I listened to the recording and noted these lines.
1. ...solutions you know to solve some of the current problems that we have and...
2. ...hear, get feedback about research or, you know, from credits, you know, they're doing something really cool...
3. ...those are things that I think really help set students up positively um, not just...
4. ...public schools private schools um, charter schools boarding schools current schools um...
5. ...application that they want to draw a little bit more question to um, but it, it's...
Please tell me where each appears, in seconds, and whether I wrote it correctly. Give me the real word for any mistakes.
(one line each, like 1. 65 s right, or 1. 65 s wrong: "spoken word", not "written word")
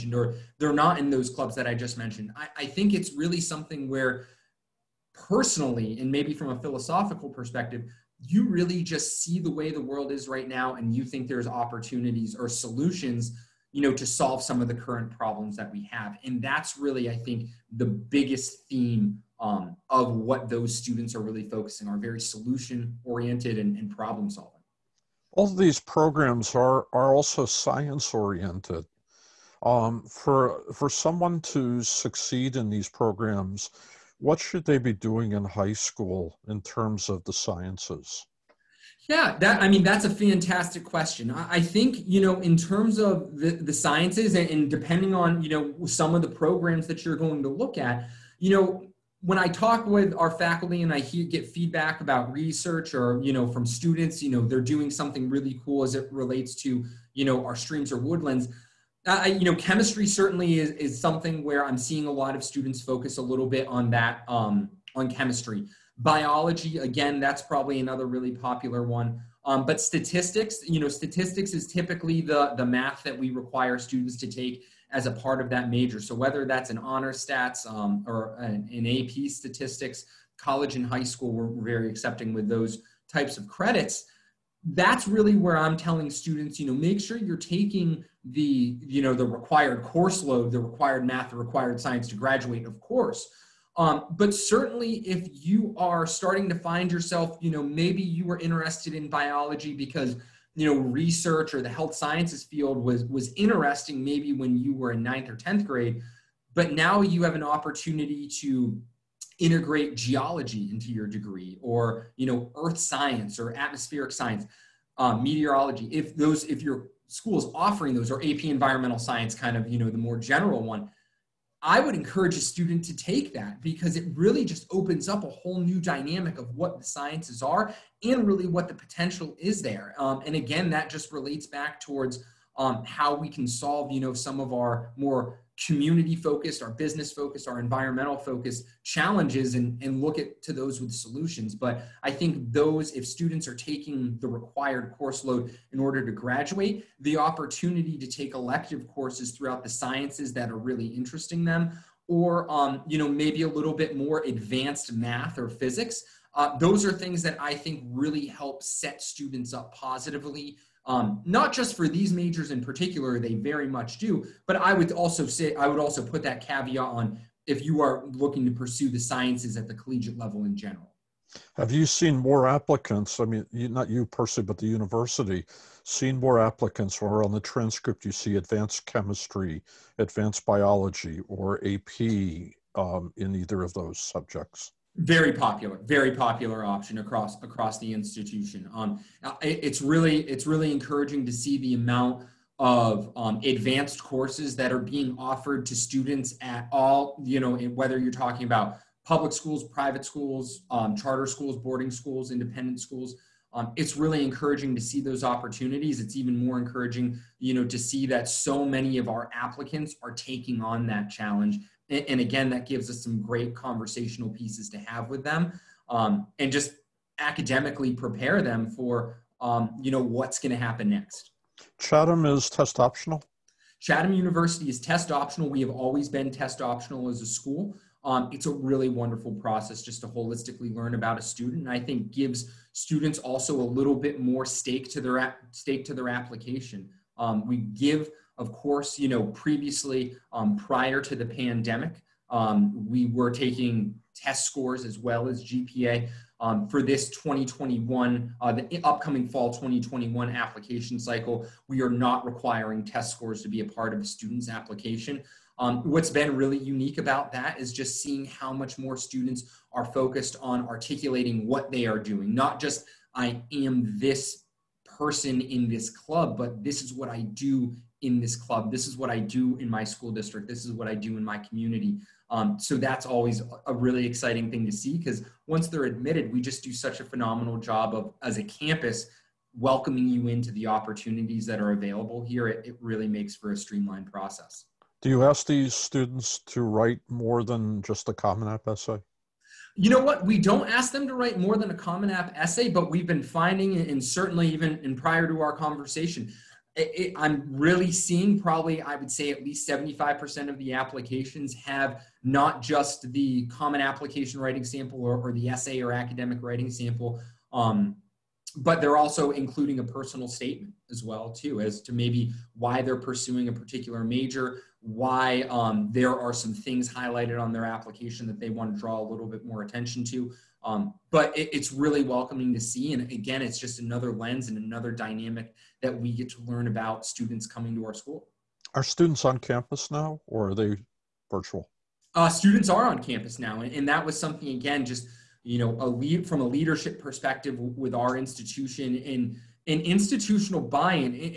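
1. 12 s right
2. 50 s wrong: "students", not "credits"
3. 156 s right
4. 199 s wrong: "independent", not "current"
5. 317 s wrong: "attention", not "question".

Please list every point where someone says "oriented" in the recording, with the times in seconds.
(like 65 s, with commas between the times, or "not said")
23 s, 28 s.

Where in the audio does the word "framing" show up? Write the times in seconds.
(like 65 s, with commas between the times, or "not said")
not said.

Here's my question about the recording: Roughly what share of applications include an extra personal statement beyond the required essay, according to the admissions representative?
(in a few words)
75%.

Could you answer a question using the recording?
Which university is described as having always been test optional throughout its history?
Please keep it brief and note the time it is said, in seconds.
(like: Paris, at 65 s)
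Chatham University, at 223 s.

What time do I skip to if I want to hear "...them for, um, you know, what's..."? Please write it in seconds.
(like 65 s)
218 s.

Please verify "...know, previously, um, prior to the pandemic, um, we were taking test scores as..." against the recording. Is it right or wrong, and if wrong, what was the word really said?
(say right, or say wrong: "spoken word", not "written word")
right.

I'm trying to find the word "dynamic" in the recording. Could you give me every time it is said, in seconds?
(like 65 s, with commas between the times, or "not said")
125 s, 324 s.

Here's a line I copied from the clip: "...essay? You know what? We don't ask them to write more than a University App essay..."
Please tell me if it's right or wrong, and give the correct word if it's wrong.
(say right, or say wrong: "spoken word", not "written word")
wrong: "Common", not "University".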